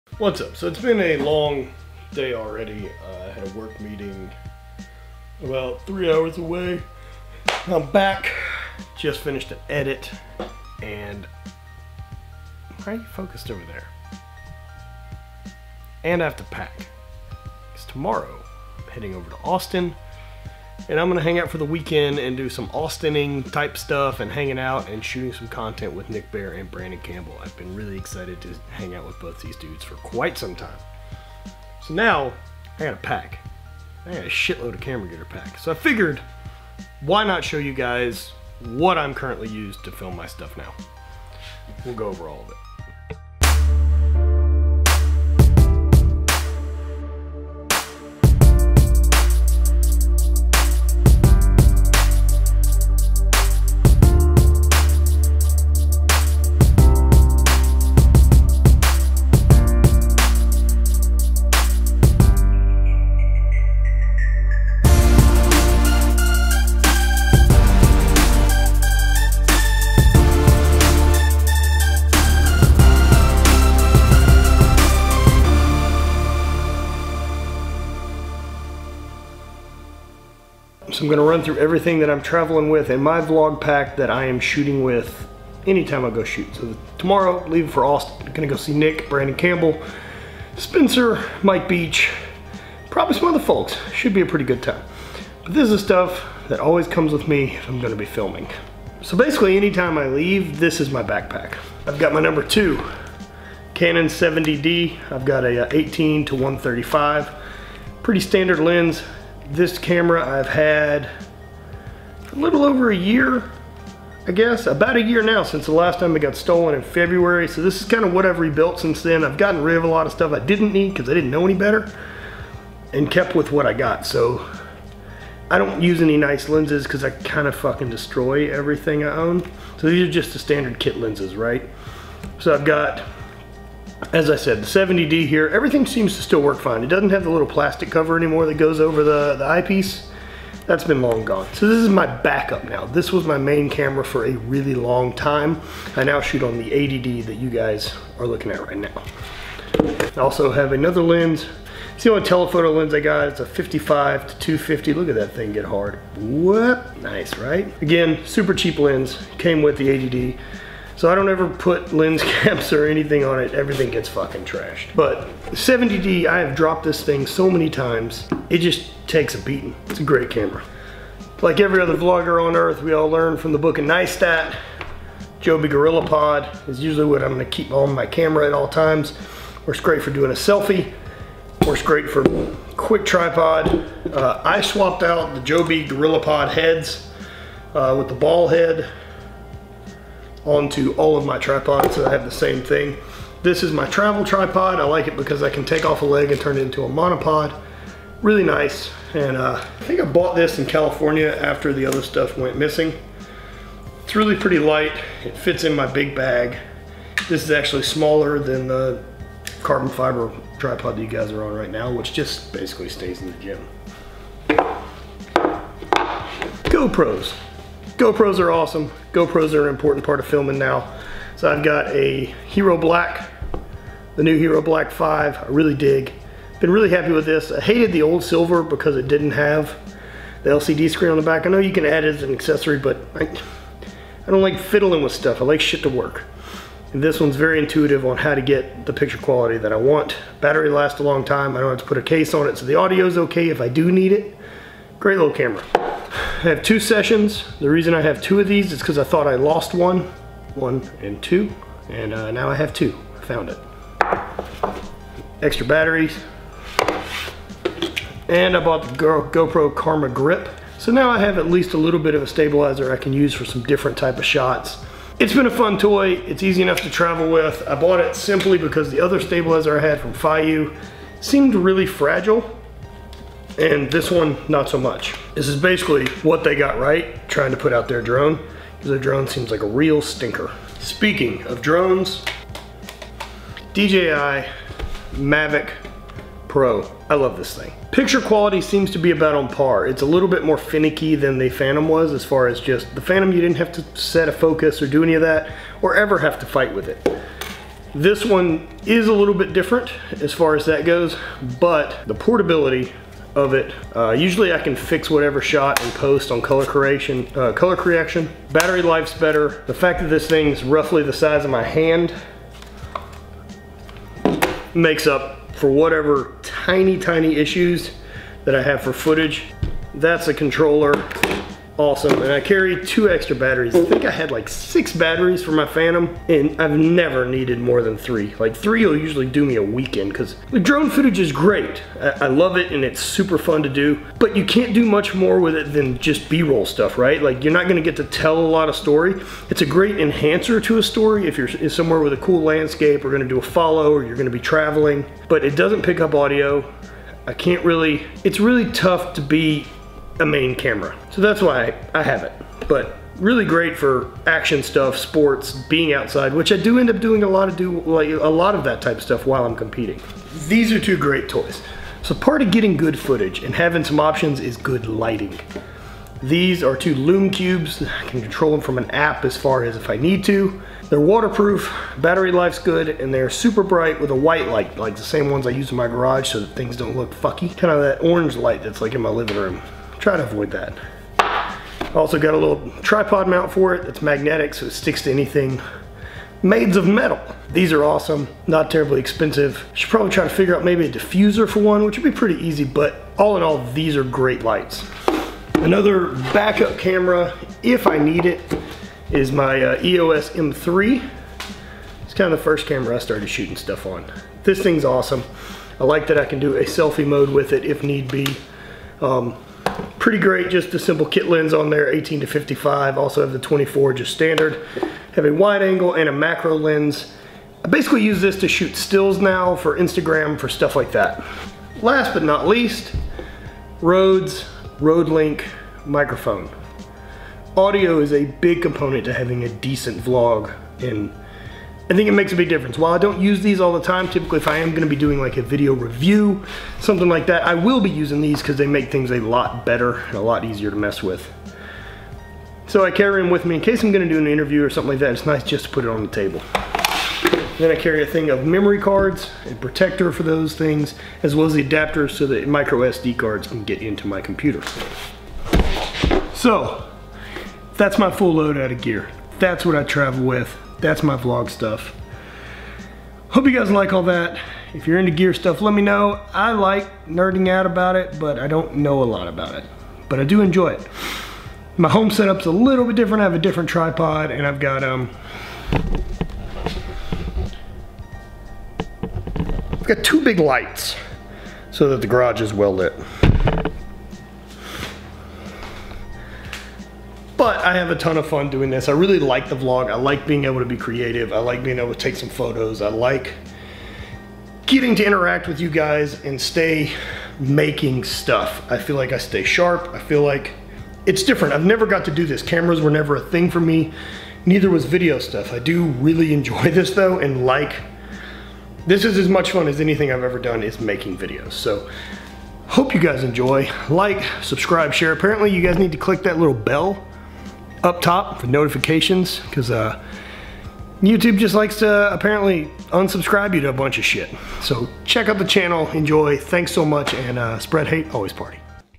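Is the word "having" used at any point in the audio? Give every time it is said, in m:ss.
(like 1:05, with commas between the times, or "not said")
6:03, 7:09.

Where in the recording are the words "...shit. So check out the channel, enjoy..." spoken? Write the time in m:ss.
8:44.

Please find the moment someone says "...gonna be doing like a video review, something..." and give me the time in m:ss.
7:14.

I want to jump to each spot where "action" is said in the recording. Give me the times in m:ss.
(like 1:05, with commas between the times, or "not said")
5:54.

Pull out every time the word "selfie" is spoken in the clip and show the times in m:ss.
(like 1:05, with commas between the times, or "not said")
3:00, 6:46.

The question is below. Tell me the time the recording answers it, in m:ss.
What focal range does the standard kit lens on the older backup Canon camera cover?
1:45.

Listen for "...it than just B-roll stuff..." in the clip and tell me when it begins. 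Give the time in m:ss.
5:35.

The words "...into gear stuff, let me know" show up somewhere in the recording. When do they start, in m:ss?
7:44.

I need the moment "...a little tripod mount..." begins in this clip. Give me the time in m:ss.
6:22.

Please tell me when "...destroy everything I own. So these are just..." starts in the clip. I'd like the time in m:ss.
2:07.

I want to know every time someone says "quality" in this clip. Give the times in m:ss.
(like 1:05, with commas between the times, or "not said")
3:59, 4:48.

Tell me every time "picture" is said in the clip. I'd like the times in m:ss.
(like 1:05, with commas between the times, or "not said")
3:58, 4:47.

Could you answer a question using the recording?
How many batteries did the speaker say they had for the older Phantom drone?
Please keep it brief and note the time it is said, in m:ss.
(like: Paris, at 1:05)
6, at 5:24.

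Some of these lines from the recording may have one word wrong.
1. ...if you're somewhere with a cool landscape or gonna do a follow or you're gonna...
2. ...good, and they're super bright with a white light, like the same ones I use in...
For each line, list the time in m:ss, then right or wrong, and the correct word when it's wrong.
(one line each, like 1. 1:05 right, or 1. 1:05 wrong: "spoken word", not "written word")
1. 5:41 right
2. 6:12 right.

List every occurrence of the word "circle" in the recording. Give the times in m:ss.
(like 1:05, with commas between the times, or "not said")
not said.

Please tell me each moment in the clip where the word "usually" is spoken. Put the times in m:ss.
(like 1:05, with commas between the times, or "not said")
2:56, 5:04, 5:28.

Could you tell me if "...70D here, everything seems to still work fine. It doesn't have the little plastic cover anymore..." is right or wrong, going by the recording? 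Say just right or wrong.
right.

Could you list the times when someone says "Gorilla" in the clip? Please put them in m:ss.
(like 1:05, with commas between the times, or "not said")
2:55, 3:05.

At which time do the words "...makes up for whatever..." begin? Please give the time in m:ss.
5:14.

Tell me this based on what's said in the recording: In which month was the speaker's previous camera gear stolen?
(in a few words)
February.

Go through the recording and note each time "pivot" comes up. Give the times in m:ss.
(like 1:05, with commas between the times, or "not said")
not said.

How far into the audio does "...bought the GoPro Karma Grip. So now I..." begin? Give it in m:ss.
4:18.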